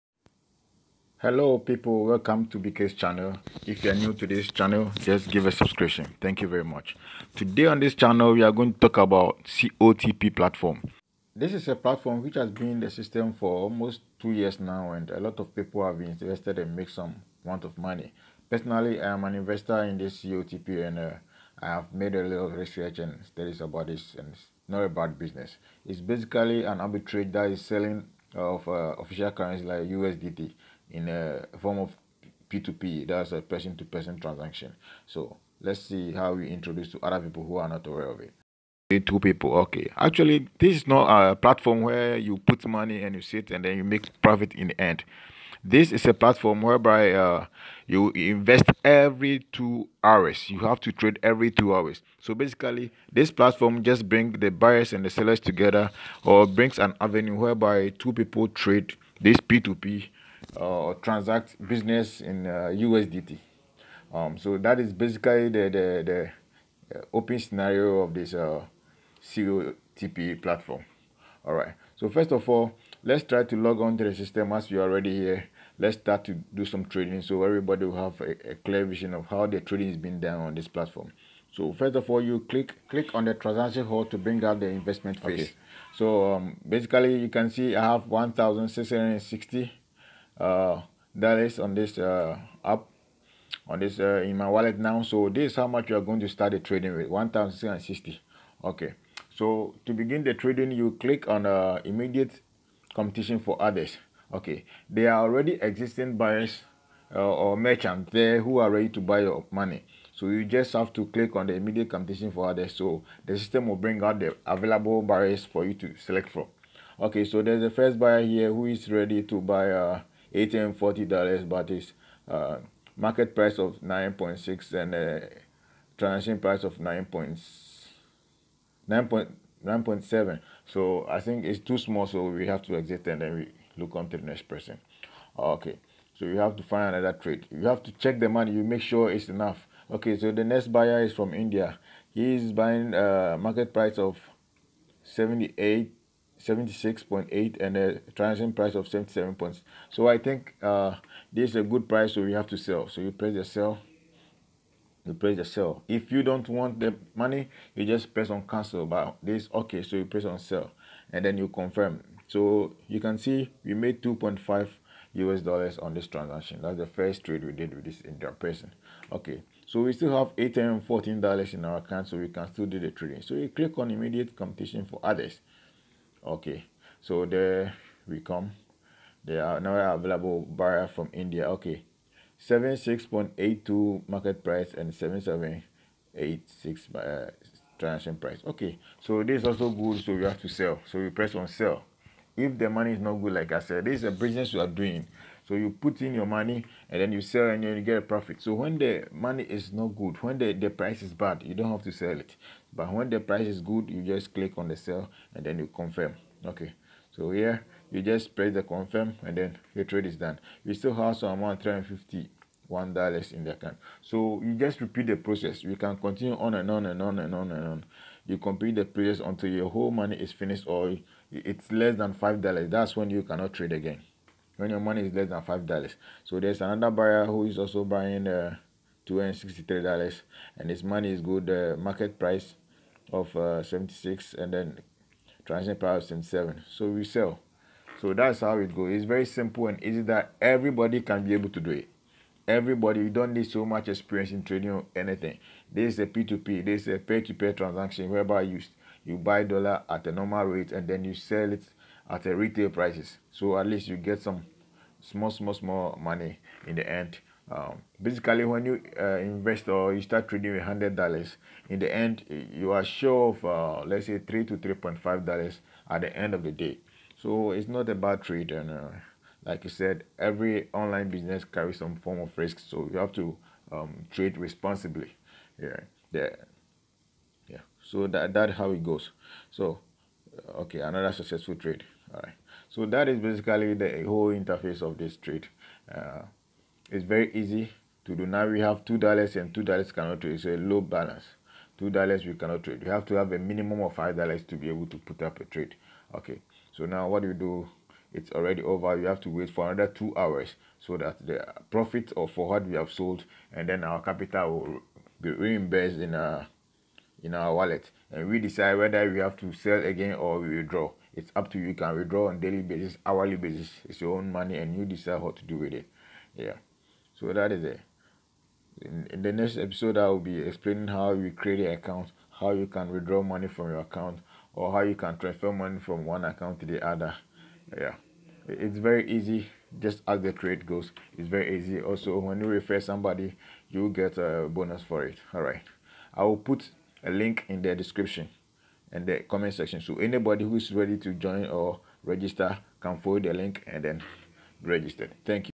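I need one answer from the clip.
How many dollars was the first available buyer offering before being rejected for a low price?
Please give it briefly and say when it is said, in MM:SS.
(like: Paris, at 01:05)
$840, at 02:00.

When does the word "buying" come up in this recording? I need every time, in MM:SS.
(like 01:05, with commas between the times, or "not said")
02:22, 03:47.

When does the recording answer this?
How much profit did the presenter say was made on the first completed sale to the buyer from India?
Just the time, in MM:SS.
02:44.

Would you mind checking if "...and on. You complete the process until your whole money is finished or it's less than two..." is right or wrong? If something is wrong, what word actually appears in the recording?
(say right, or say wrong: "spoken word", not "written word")
wrong: "five", not "two".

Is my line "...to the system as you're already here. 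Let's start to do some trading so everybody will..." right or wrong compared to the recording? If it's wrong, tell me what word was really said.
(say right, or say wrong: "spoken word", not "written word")
right.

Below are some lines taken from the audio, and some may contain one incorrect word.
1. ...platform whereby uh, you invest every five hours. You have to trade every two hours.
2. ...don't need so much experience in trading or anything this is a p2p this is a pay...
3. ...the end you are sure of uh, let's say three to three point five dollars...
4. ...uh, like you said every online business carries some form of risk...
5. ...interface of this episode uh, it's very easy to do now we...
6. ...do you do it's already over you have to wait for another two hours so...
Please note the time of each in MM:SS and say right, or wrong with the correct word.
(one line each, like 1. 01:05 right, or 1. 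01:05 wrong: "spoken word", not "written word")
1. 00:46 wrong: "two", not "five"
2. 04:03 right
3. 04:21 right
4. 04:28 right
5. 04:44 wrong: "trade", not "episode"
6. 04:57 right.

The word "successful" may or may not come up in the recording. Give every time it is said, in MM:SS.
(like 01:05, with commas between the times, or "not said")
04:41.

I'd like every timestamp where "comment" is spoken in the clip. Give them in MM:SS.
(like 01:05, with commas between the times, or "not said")
05:39.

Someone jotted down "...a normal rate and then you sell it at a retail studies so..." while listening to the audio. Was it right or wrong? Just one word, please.
wrong.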